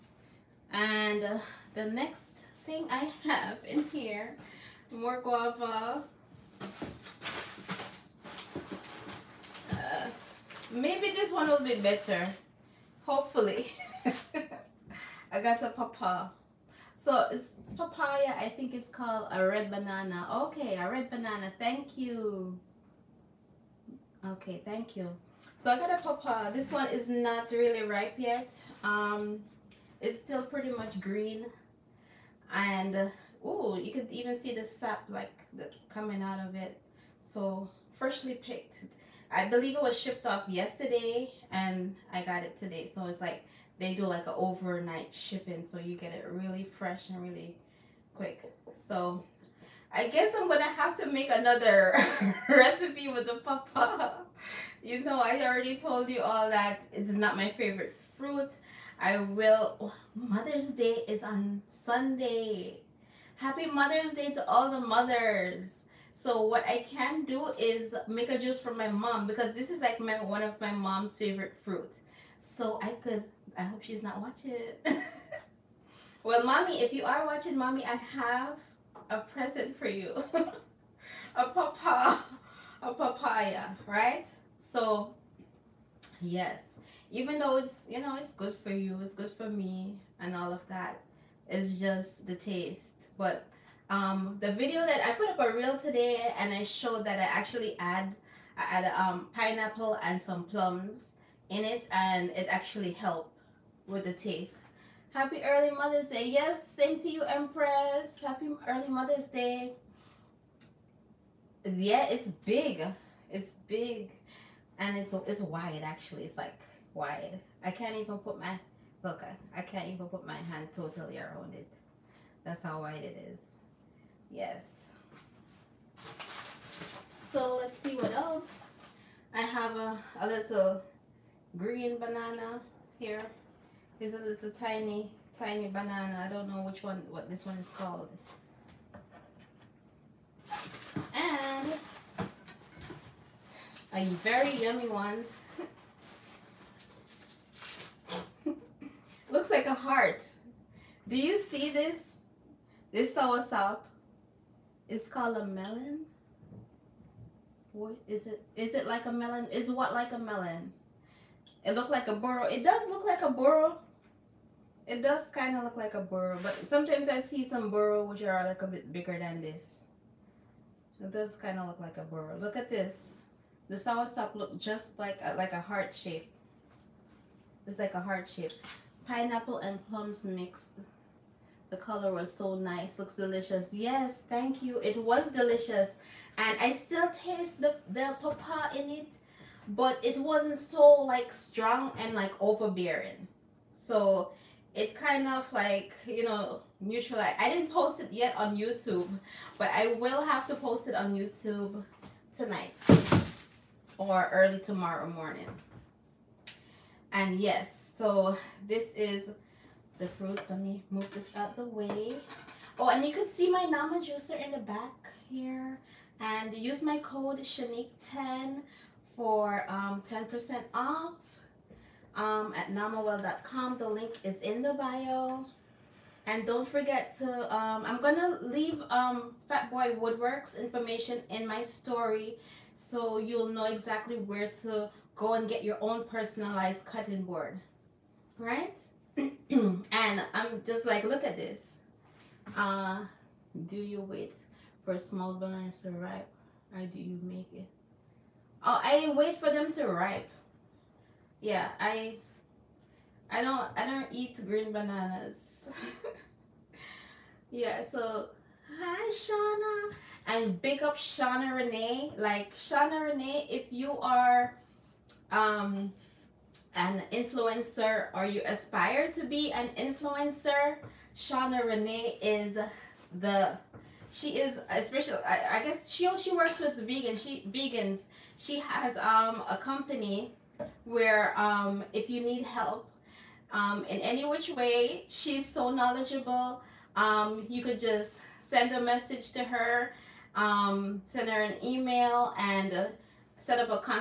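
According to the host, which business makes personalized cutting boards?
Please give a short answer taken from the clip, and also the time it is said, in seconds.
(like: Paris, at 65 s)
Fat Boy Woodworks, at 229 s.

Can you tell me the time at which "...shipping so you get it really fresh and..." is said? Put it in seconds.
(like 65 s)
45 s.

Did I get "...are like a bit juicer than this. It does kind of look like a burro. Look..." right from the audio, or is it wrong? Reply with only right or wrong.
wrong.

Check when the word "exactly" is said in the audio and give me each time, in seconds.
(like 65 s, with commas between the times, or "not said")
233 s.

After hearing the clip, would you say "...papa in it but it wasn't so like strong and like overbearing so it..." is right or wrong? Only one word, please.
right.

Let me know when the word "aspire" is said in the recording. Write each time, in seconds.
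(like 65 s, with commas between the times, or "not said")
268 s.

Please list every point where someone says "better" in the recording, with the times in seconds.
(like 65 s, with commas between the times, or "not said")
11 s.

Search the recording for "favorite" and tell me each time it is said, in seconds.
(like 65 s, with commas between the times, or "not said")
57 s, 71 s.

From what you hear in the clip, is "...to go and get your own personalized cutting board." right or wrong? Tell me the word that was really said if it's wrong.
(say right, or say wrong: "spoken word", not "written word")
right.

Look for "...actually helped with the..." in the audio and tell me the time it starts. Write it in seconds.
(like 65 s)
102 s.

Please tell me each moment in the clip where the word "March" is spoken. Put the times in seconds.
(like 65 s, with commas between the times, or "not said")
not said.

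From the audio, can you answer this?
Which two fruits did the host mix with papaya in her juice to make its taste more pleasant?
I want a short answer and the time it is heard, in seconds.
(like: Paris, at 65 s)
Pineapple and plums, at 99 s.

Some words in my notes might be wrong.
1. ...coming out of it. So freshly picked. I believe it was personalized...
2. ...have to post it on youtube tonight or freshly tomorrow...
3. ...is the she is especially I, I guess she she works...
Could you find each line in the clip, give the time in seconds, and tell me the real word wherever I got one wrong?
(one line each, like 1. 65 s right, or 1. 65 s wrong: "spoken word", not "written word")
1. 35 s wrong: "shipped", not "personalized"
2. 200 s wrong: "early", not "freshly"
3. 272 s right.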